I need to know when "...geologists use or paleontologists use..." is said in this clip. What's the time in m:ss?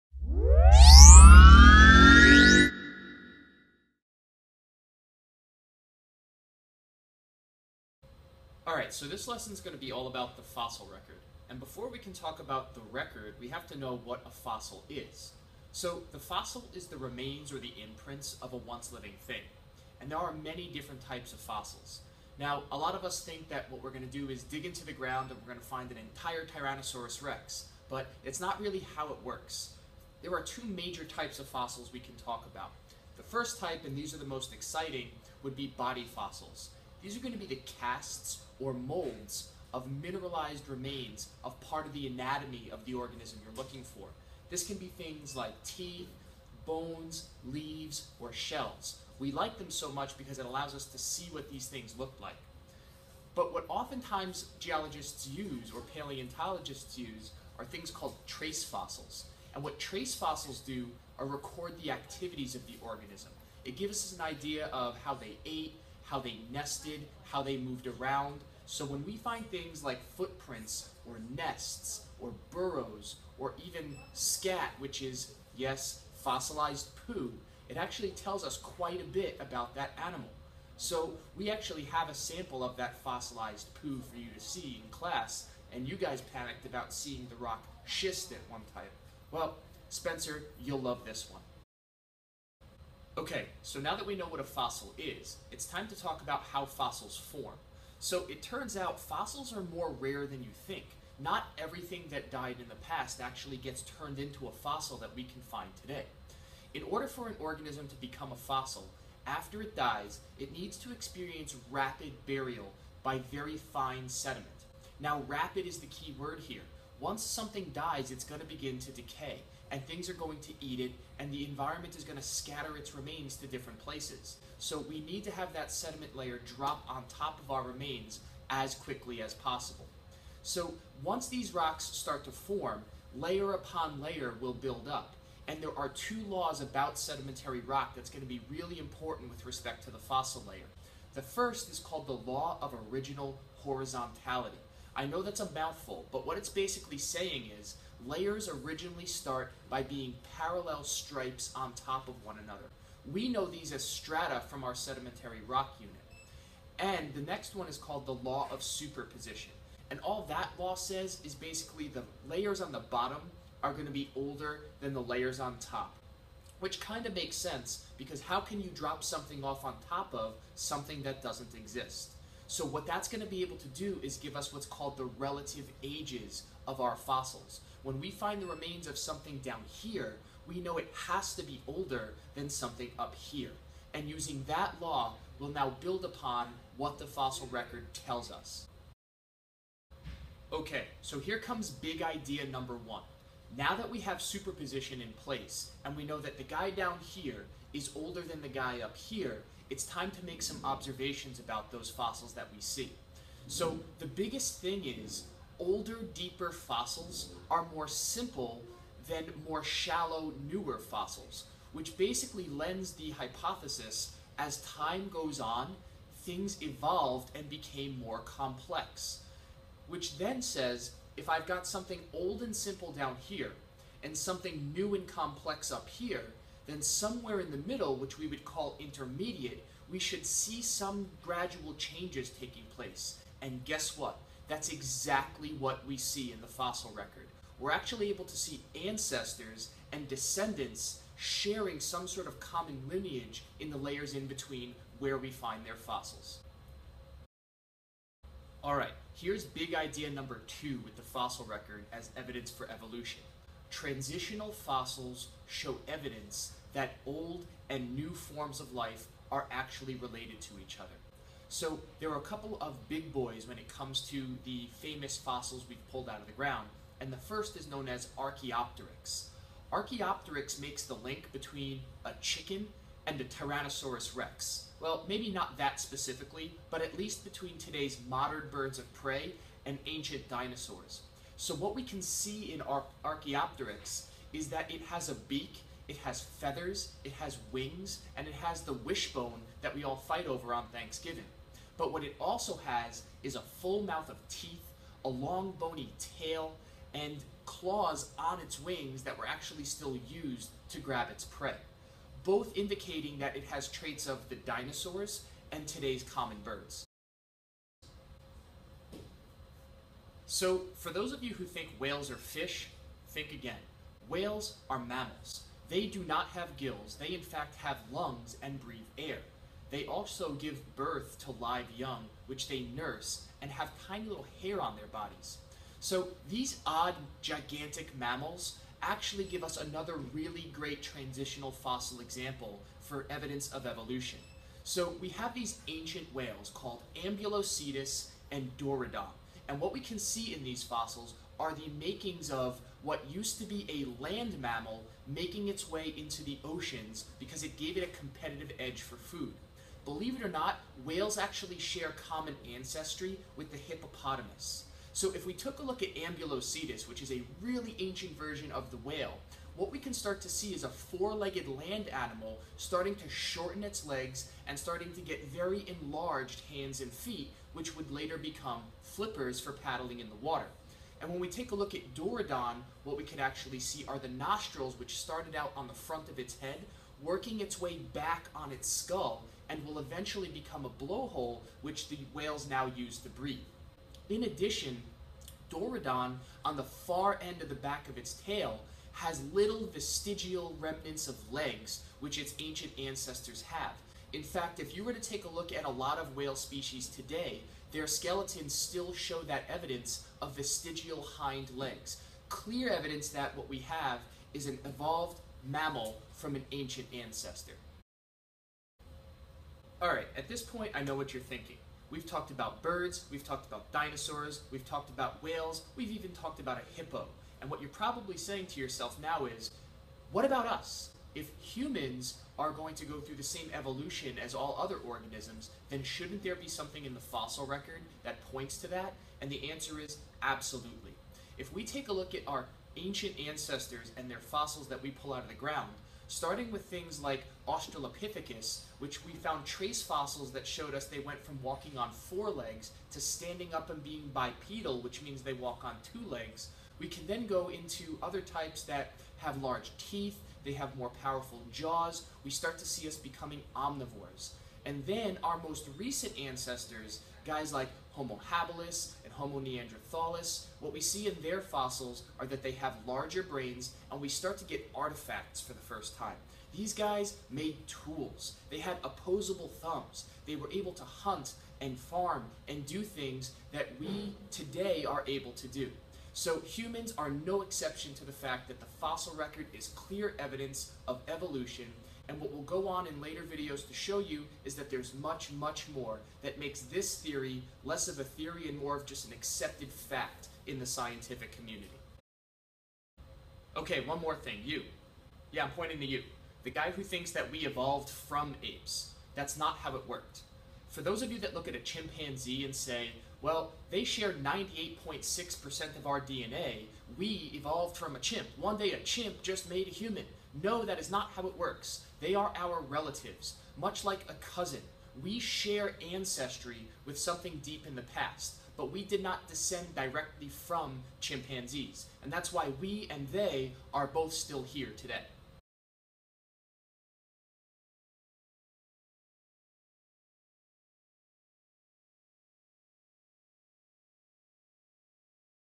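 0:54.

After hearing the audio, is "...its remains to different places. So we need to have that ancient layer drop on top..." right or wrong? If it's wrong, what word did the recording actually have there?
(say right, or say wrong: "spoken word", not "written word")
wrong: "sediment", not "ancient".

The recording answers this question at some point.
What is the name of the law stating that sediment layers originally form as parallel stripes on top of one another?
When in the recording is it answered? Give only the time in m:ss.
2:22.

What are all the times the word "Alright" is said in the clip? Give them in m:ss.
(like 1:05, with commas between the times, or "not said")
0:08, 4:08, 6:49.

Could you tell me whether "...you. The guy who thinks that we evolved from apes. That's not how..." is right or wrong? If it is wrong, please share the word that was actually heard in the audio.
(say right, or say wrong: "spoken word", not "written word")
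right.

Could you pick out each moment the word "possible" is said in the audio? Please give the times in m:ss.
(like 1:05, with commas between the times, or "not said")
2:09.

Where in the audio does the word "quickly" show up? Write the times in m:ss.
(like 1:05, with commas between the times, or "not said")
2:08.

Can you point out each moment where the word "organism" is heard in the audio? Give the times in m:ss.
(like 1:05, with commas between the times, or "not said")
0:42, 1:02, 1:47, 7:04.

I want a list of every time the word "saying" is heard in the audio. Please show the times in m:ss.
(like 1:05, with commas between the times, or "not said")
2:26, 6:58.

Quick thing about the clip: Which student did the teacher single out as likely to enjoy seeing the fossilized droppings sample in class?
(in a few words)
Spencer.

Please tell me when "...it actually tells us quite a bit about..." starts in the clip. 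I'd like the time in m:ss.
1:17.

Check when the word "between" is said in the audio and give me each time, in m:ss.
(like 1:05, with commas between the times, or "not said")
4:04, 4:31, 4:37.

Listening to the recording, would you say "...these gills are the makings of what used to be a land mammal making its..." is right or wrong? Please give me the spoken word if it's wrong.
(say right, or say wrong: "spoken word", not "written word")
wrong: "fossils", not "gills".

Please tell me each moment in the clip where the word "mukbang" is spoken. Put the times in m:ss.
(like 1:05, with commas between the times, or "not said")
not said.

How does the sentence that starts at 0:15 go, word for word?
So the fossil is the remains or the imprints of a once living thing.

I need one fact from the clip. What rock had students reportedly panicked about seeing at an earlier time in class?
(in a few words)
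schist.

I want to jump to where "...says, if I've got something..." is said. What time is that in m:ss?
3:40.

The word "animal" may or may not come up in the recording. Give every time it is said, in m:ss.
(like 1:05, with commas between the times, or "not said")
1:20, 6:01.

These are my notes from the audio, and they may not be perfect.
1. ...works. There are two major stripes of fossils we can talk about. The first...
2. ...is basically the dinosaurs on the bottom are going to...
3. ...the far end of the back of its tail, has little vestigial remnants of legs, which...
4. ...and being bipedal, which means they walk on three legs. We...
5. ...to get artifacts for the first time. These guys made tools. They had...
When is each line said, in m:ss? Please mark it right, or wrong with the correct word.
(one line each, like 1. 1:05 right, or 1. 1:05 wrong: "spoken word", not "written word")
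1. 0:29 wrong: "types", not "stripes"
2. 2:41 wrong: "layers", not "dinosaurs"
3. 6:26 right
4. 7:23 wrong: "two", not "three"
5. 7:44 right.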